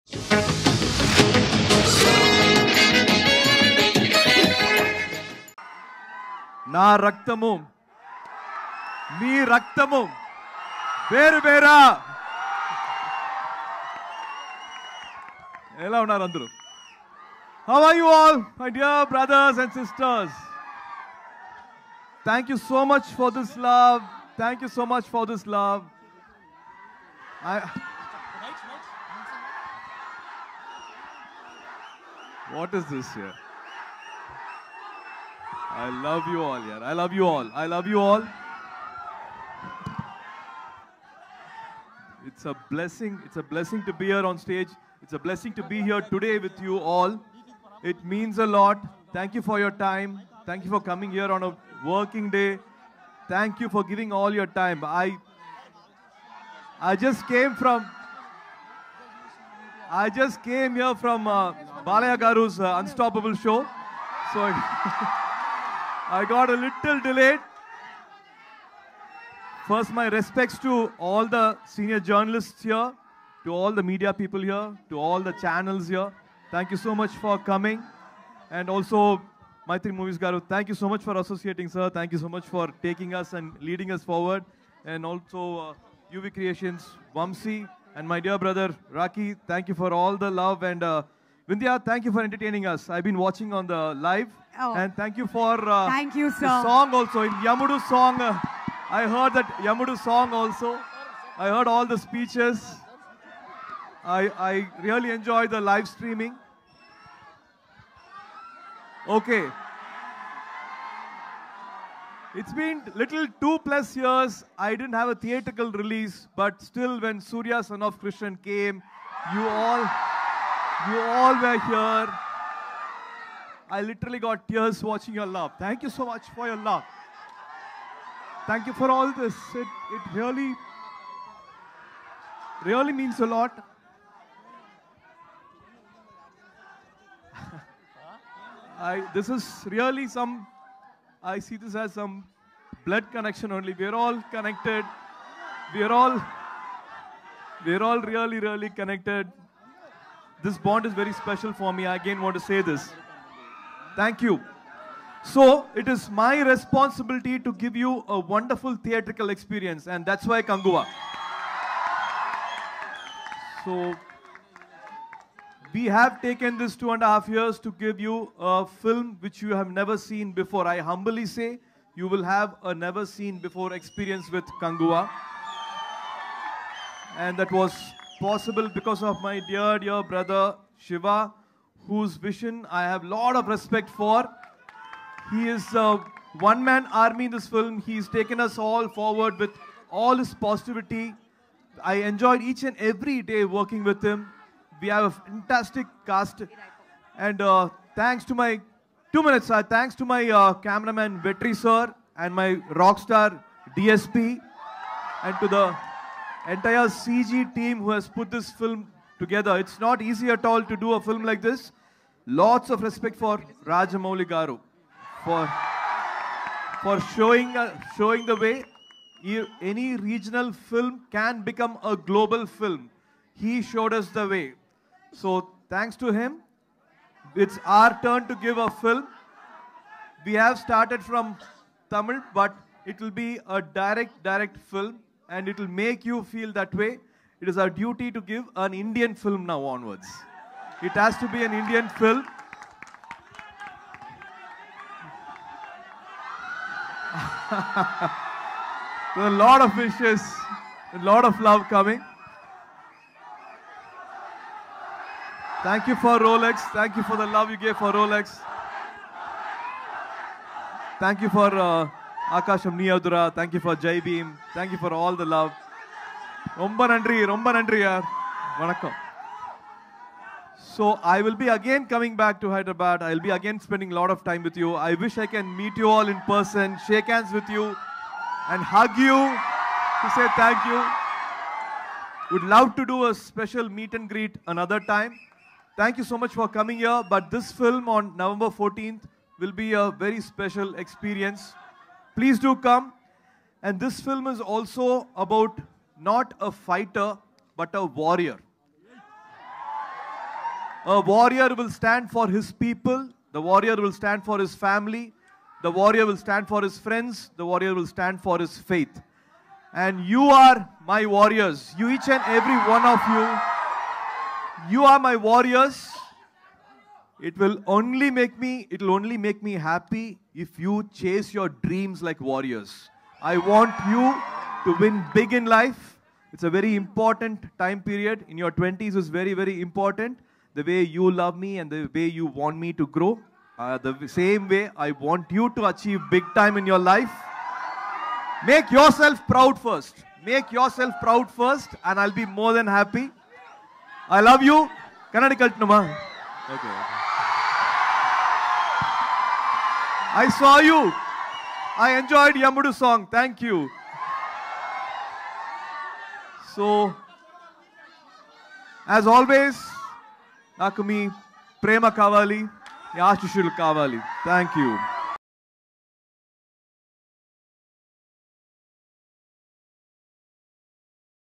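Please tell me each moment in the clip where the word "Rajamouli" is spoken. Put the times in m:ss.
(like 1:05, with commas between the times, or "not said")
3:33.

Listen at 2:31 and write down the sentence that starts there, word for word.
I again want to say this.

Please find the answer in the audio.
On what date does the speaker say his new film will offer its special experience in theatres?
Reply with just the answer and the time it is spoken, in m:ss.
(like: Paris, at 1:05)
November 14, at 4:48.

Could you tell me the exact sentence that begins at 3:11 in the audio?
I enjoyed each and every day working with him.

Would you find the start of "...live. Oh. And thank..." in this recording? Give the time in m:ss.
1:33.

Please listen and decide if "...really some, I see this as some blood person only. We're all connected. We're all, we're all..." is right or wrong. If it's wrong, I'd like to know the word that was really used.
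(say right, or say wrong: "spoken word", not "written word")
wrong: "connection", not "person".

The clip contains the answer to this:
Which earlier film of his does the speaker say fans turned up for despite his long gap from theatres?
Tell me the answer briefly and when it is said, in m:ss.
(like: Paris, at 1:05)
Surya Son of Krishnan, at 1:57.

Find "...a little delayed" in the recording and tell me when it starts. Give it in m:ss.
1:06.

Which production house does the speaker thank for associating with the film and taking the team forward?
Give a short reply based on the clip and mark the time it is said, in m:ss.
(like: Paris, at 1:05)
Maitri Movies, at 1:19.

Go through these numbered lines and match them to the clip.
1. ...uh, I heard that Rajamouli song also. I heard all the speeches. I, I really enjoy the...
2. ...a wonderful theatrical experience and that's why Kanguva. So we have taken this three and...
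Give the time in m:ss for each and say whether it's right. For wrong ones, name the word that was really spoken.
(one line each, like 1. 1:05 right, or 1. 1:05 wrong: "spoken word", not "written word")
1. 1:38 wrong: "Yamudu", not "Rajamouli"
2. 2:38 wrong: "two", not "three".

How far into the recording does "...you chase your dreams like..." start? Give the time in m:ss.
5:20.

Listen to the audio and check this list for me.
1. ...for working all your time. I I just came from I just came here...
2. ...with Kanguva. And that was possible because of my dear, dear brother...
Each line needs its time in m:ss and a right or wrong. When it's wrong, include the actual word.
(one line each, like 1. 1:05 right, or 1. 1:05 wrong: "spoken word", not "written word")
1. 0:53 wrong: "giving", not "working"
2. 2:54 right.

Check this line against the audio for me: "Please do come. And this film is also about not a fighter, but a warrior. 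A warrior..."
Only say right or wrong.
right.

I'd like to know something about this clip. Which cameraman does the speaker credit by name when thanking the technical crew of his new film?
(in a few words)
Vetri.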